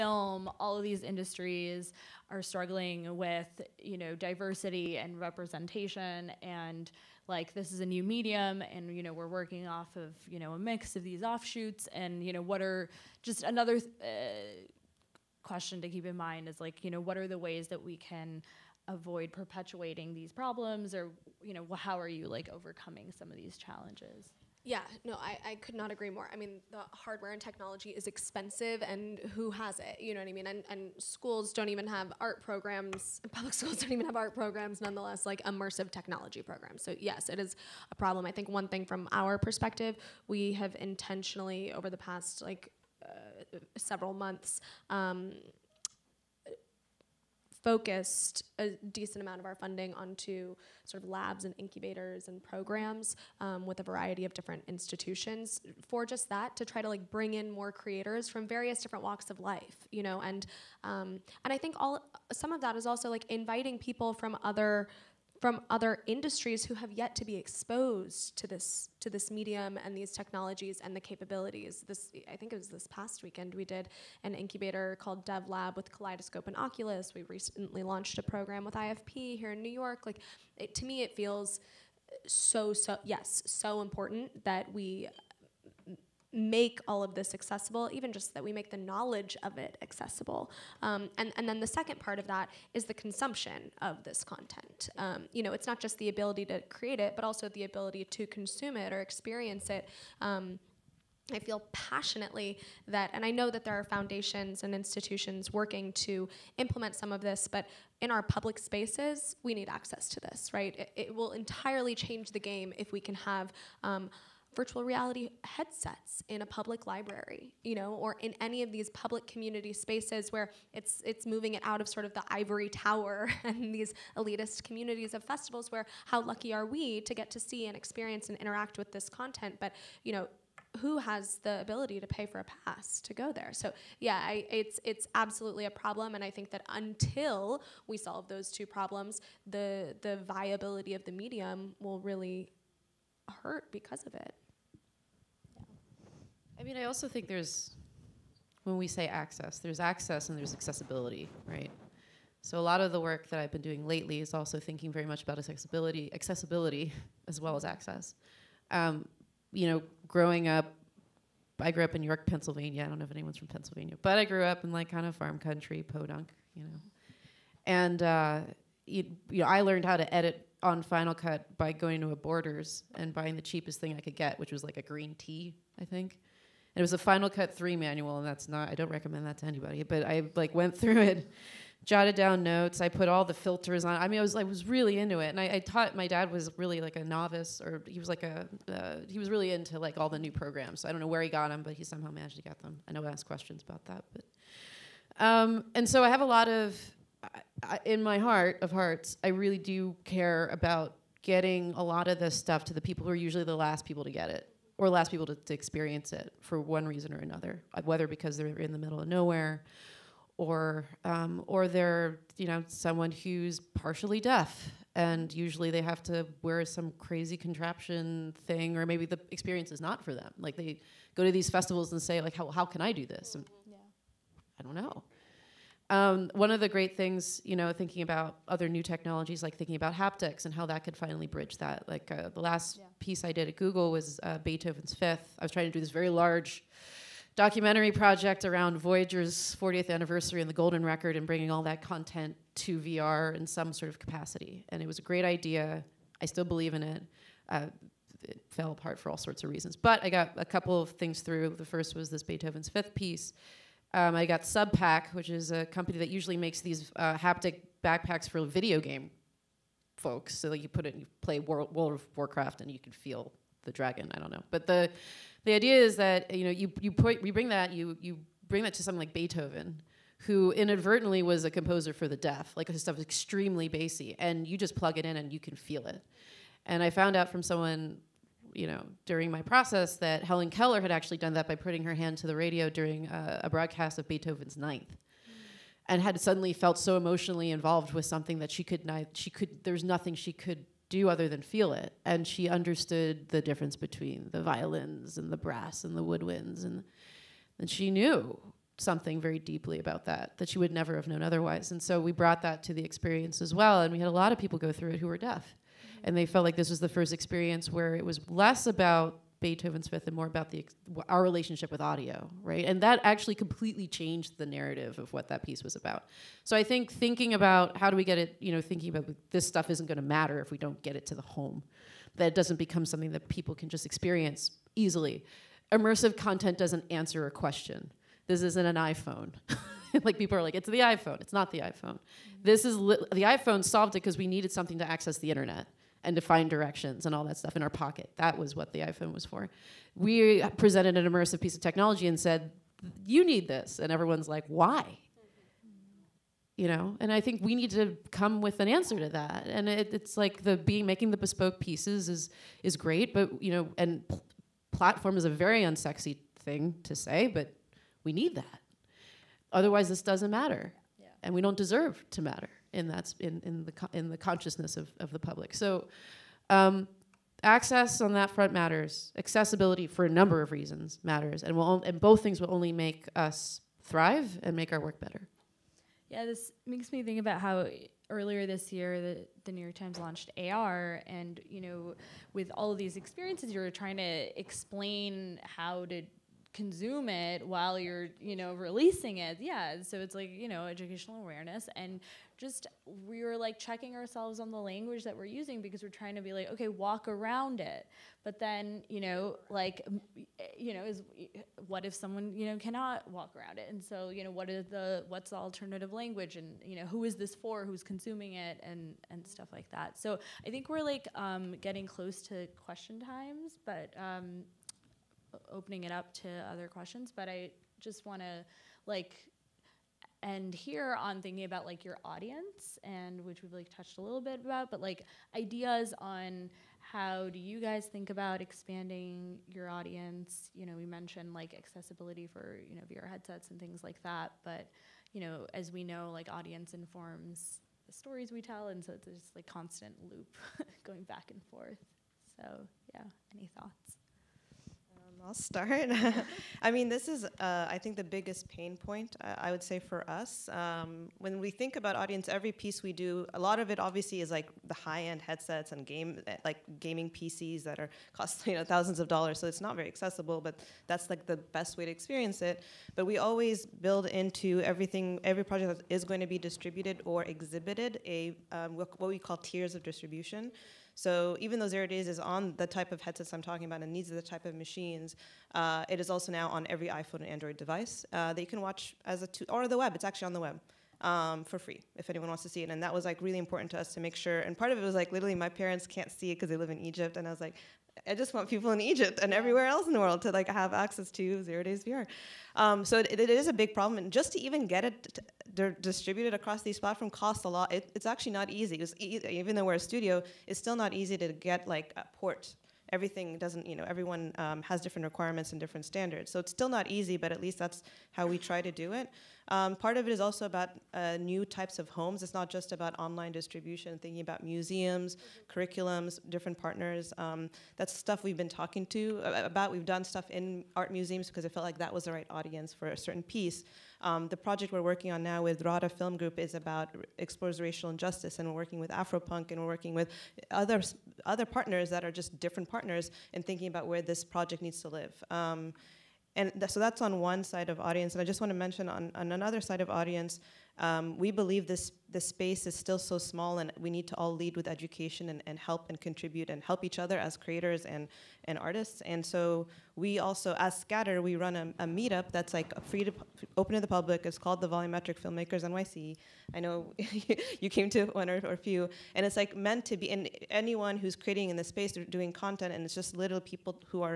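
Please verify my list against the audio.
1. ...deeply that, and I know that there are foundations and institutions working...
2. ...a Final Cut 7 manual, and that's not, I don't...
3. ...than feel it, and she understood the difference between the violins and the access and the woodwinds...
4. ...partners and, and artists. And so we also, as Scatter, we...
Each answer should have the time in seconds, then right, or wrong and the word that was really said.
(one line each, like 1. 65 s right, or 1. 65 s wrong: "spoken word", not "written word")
1. 101 s wrong: "passionately", not "deeply"
2. 176 s wrong: "3", not "7"
3. 291 s wrong: "brass", not "access"
4. 547 s wrong: "creators", not "partners".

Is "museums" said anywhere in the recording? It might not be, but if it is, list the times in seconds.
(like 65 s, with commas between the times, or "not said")
514 s, 520 s.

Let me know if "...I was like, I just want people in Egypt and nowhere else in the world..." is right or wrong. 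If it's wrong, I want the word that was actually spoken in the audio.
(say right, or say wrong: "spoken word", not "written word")
wrong: "everywhere", not "nowhere".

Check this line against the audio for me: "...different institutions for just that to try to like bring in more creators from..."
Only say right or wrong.
right.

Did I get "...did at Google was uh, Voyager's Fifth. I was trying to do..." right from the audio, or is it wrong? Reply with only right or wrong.
wrong.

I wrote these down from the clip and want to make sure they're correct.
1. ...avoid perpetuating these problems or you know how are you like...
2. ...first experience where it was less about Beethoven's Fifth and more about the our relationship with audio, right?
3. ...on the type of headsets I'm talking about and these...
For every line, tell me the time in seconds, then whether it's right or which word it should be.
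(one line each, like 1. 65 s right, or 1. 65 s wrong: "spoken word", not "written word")
1. 18 s right
2. 306 s right
3. 472 s right.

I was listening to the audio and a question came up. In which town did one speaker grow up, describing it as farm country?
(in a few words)
York, Pennsylvania.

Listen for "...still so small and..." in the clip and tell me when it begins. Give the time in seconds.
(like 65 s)
542 s.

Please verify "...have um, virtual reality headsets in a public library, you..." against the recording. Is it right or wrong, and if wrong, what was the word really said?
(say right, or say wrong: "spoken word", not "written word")
right.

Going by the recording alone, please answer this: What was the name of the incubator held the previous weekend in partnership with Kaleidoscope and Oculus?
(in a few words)
DevLab.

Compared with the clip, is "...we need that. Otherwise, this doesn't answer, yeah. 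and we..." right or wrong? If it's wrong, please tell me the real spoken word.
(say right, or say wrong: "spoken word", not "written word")
wrong: "matter", not "answer".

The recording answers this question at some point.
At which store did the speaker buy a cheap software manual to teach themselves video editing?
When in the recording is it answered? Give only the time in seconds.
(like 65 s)
172 s.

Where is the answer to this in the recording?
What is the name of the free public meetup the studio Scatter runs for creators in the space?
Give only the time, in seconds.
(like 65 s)
554 s.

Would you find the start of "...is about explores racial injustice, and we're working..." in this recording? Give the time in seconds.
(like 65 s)
526 s.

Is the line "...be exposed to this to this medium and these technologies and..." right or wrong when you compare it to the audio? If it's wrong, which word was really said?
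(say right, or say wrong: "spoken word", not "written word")
right.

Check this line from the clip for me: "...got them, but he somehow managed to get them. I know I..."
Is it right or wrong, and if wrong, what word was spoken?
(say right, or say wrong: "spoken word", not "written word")
right.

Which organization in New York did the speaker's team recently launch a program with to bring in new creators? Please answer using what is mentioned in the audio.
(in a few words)
IFP.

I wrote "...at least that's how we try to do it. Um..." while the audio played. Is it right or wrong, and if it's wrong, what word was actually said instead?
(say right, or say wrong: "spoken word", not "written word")
right.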